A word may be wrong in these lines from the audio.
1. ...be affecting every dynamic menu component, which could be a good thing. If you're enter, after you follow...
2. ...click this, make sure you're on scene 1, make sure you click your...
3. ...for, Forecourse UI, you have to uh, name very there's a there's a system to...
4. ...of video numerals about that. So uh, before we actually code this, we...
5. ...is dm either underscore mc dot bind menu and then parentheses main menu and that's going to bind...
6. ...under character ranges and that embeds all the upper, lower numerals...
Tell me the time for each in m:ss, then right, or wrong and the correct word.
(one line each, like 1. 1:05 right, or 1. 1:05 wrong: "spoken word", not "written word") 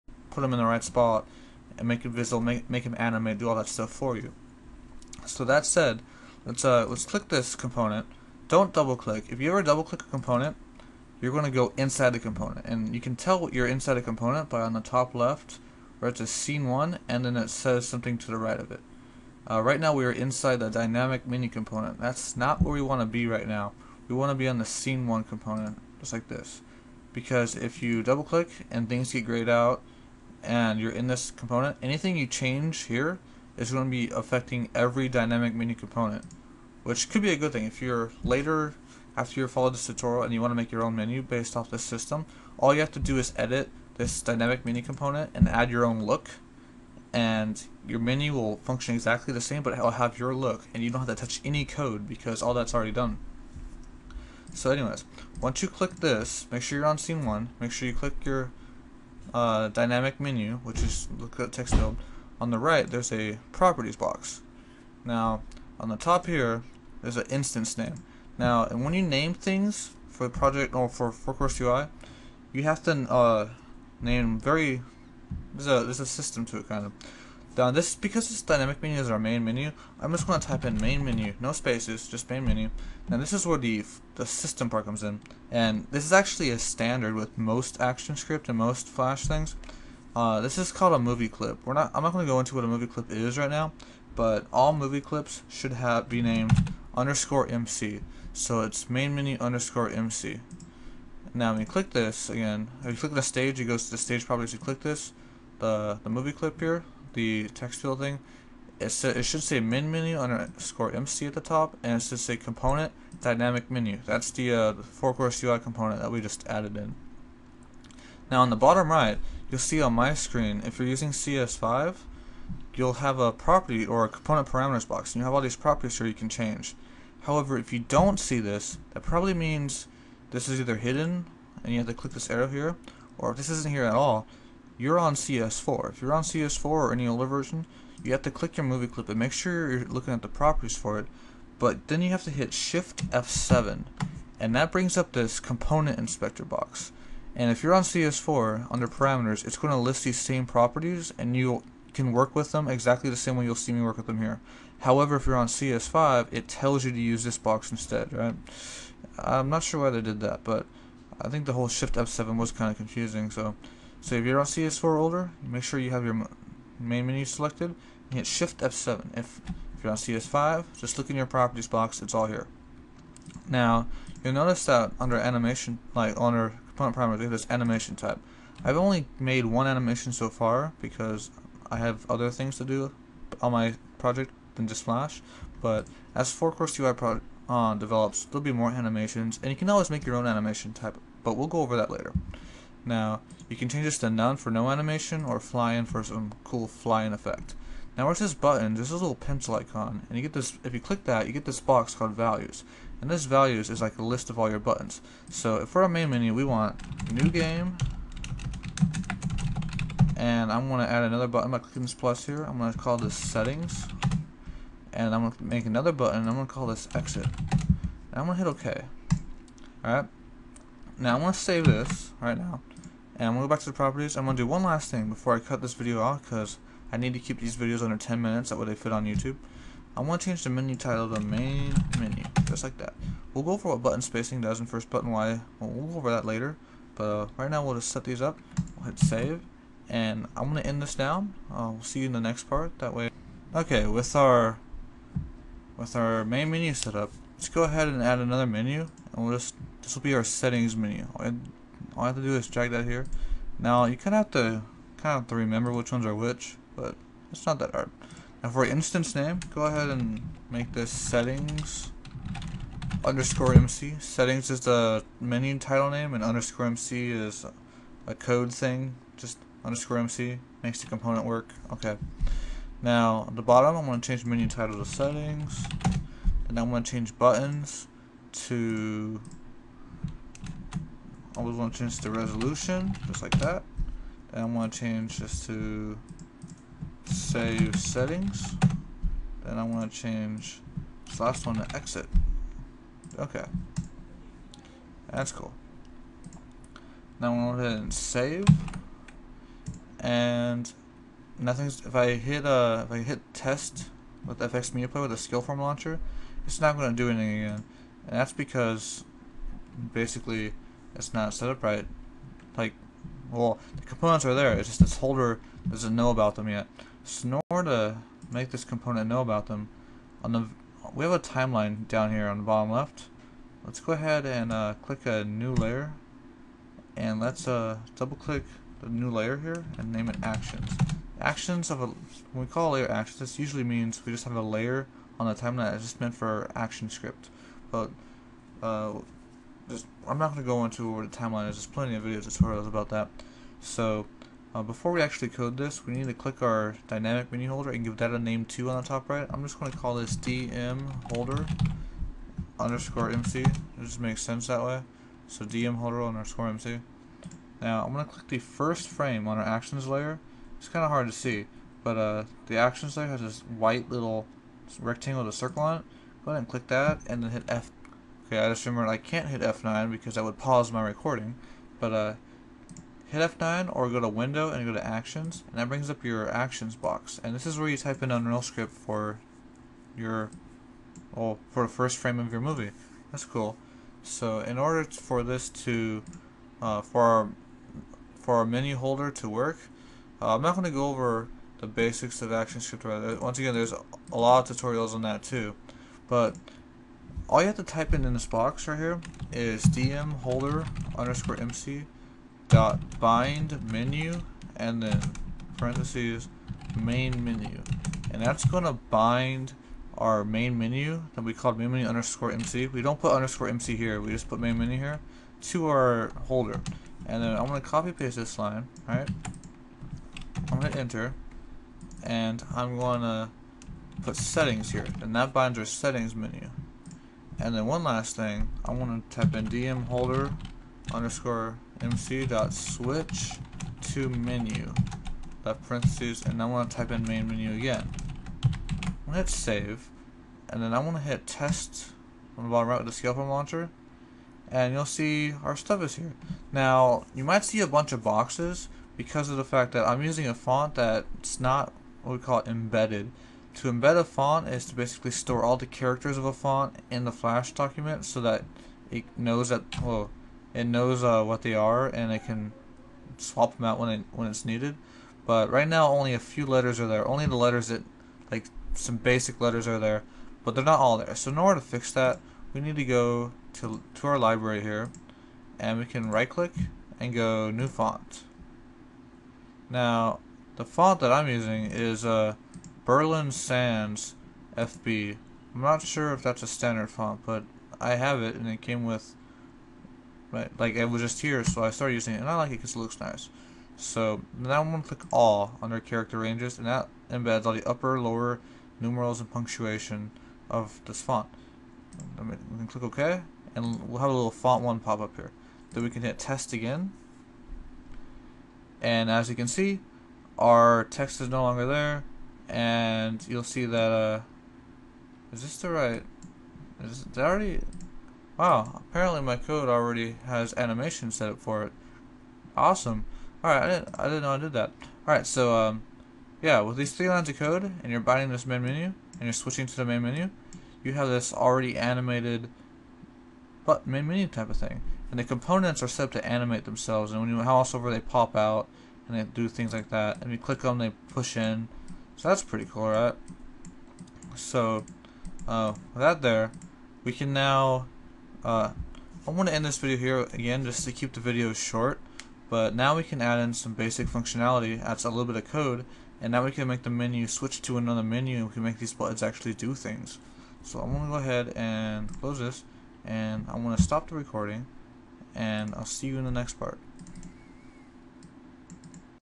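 1. 0:33 wrong: "later", not "enter"
2. 0:55 right
3. 1:10 right
4. 5:41 wrong: "tutorials", not "numerals"
5. 6:39 wrong: "holder", not "either"
6. 8:15 right.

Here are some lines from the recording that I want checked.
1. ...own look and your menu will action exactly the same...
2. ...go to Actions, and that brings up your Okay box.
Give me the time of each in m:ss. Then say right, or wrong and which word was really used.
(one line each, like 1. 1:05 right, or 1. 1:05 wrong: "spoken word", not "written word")
1. 0:45 wrong: "function", not "action"
2. 6:14 wrong: "Actions", not "Okay".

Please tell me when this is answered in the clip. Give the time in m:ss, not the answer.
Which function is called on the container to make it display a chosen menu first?
7:12.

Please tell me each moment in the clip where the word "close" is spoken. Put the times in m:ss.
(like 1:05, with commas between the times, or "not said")
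9:22.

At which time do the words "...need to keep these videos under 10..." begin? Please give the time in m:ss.
3:46.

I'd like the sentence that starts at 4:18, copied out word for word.
Now for instance name, go ahead and make this settings underscore MC.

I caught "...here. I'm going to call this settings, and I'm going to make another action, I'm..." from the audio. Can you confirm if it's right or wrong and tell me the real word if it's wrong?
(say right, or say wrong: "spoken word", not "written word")
wrong: "button", not "action".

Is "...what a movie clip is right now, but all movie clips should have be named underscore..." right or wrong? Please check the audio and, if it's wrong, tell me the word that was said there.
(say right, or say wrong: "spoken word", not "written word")
right.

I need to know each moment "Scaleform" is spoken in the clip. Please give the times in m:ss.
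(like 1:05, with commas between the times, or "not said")
5:05, 7:23.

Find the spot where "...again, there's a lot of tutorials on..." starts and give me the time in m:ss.
6:33.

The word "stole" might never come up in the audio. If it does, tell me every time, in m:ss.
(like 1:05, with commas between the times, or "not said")
not said.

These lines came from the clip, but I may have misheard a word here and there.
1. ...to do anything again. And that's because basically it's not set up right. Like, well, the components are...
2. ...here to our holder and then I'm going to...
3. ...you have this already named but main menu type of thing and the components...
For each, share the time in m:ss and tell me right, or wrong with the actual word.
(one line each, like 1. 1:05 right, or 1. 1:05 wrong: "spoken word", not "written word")
1. 5:06 right
2. 6:54 right
3. 8:50 wrong: "animated", not "named".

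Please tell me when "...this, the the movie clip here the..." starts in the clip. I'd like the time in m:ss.
1:44.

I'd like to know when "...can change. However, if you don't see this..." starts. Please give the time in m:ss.
2:06.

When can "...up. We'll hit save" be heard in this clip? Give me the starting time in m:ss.
3:58.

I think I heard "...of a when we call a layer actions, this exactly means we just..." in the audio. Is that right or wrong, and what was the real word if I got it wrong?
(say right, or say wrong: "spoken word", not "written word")
wrong: "usually", not "exactly".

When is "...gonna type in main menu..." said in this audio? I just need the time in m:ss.
1:20.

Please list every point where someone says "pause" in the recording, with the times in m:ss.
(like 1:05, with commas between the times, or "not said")
6:10.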